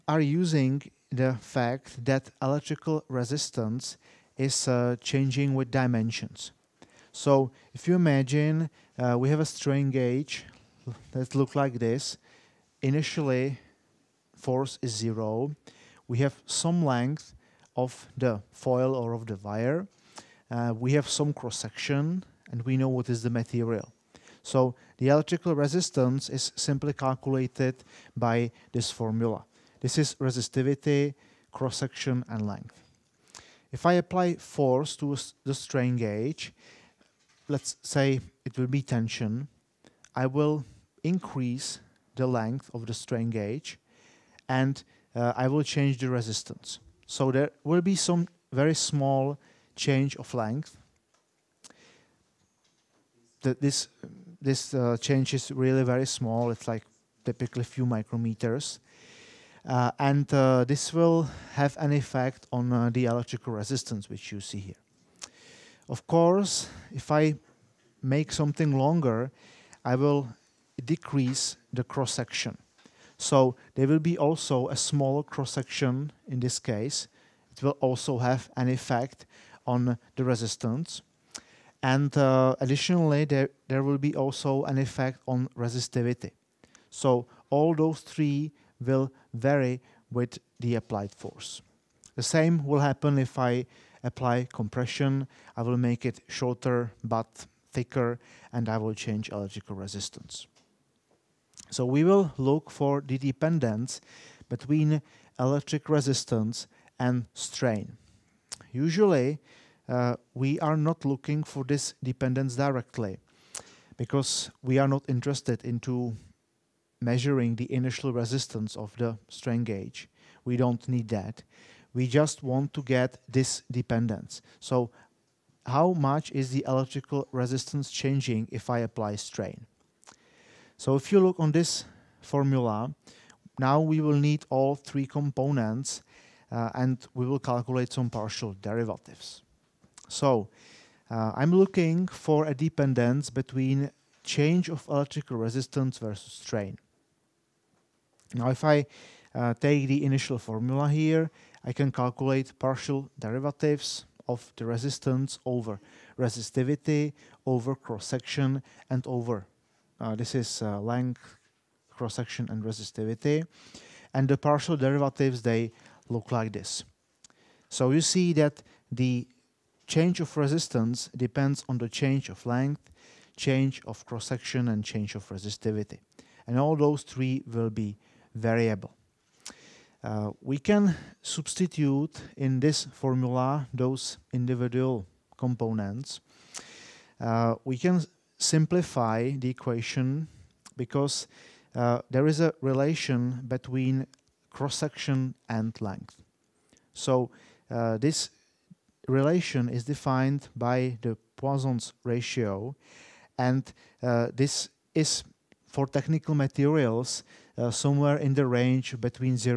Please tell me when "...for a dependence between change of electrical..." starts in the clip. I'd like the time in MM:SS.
02:22.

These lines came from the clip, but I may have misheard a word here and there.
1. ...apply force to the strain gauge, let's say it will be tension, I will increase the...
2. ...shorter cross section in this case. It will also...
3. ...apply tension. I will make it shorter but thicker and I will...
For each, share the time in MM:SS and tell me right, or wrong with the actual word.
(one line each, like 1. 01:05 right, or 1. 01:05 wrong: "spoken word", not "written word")
1. 00:33 right
2. 01:14 wrong: "smaller", not "shorter"
3. 01:34 wrong: "compression", not "tension".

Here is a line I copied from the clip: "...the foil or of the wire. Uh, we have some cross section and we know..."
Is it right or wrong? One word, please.
right.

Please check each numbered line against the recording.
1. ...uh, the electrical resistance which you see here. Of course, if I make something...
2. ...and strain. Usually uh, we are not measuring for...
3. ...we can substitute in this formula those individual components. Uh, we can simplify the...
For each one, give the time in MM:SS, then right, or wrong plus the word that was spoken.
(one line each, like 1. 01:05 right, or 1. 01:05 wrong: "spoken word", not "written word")
1. 01:02 right
2. 01:46 wrong: "looking", not "measuring"
3. 03:00 right.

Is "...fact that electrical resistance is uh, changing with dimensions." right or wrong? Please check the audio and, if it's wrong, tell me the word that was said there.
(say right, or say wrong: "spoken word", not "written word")
right.